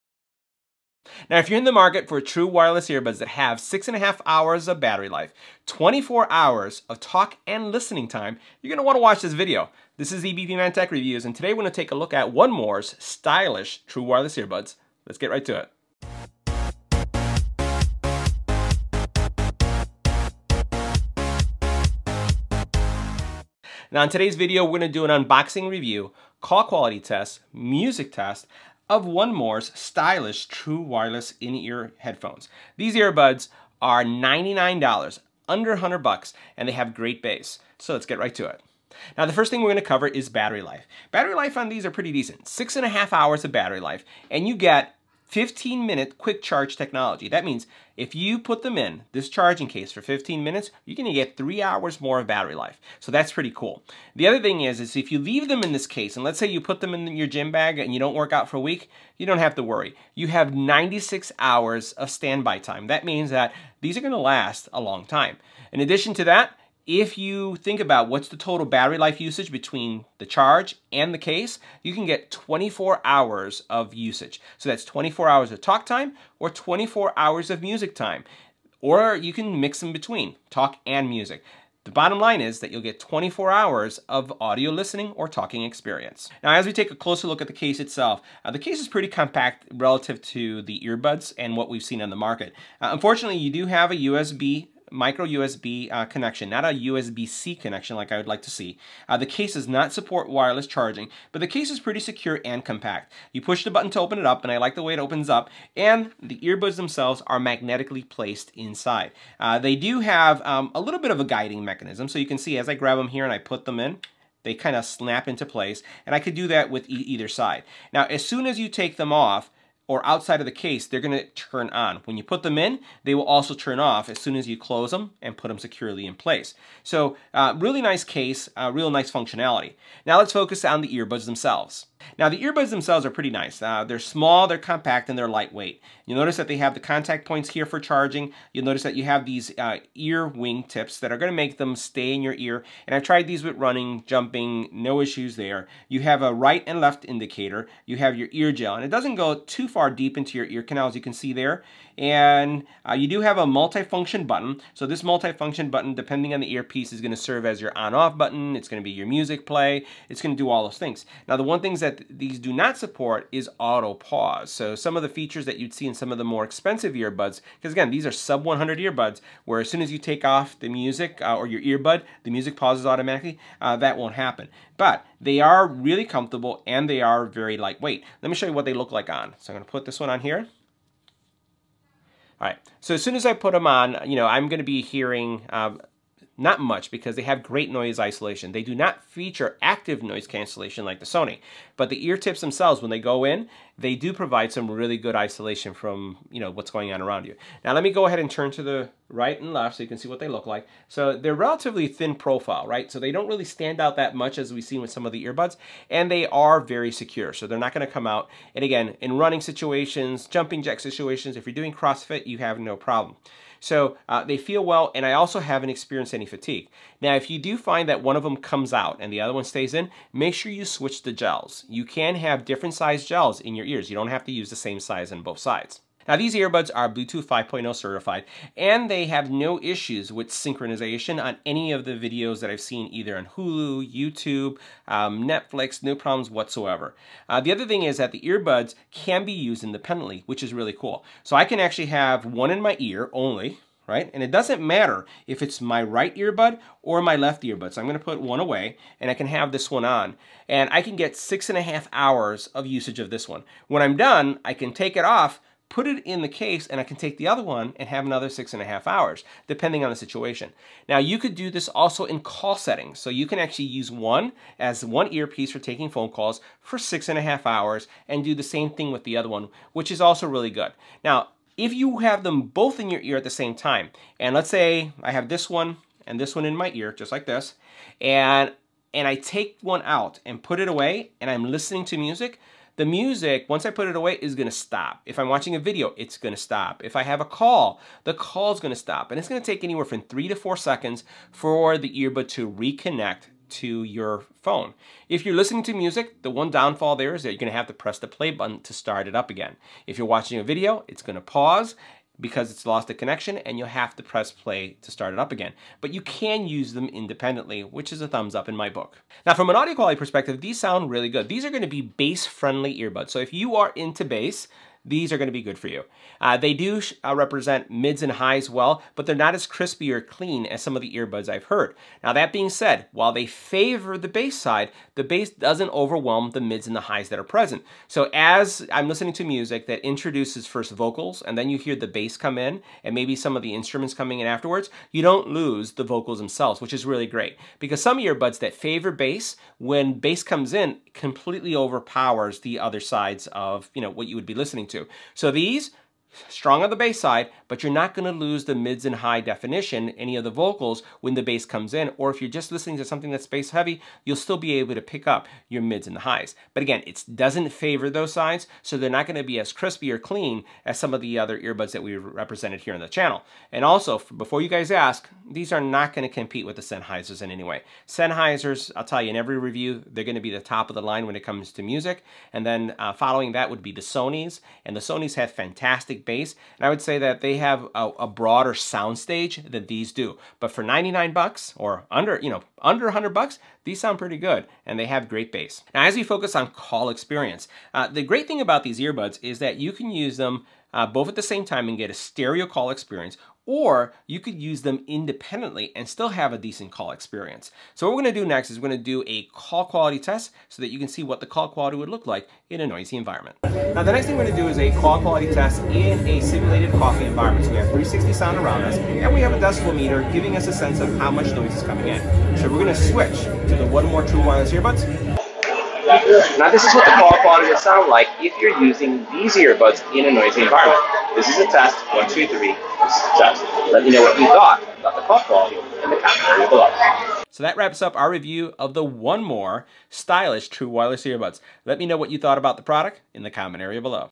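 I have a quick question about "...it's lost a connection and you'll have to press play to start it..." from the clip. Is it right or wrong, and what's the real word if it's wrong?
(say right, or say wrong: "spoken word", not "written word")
right.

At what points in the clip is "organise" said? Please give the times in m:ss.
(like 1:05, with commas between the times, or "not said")
not said.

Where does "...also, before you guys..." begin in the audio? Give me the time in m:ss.
6:03.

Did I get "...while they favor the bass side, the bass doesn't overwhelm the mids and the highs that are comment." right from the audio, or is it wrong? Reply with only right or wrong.
wrong.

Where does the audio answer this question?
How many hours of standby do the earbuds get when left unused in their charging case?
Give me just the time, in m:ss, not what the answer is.
1:00.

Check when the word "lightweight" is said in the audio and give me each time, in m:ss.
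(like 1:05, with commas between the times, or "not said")
2:15, 2:57.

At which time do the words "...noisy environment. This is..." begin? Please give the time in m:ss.
7:00.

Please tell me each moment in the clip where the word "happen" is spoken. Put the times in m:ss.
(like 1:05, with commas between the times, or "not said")
2:54.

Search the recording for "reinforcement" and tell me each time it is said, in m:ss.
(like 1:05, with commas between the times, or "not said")
not said.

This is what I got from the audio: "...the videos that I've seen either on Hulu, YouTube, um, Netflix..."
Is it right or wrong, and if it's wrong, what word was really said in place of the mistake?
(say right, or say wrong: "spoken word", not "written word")
right.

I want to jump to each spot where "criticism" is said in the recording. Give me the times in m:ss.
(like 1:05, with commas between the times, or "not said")
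not said.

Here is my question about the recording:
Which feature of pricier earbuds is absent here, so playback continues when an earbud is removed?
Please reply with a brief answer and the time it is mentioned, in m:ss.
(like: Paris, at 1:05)
auto pause, at 2:43.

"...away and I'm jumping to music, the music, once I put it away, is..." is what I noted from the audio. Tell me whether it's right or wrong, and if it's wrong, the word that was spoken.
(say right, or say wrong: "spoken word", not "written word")
wrong: "listening", not "jumping".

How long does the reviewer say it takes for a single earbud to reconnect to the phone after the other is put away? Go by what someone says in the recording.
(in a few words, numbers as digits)
3 to 4 seconds.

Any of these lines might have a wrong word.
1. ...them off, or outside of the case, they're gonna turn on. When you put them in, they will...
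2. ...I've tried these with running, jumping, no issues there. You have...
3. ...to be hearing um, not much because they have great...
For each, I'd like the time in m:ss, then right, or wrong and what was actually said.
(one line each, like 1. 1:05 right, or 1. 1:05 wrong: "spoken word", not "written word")
1. 1:58 right
2. 2:22 right
3. 3:04 right.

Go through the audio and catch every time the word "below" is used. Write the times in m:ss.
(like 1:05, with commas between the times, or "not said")
7:06, 7:13.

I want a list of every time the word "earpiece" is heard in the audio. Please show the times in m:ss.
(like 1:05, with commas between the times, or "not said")
2:36, 4:25.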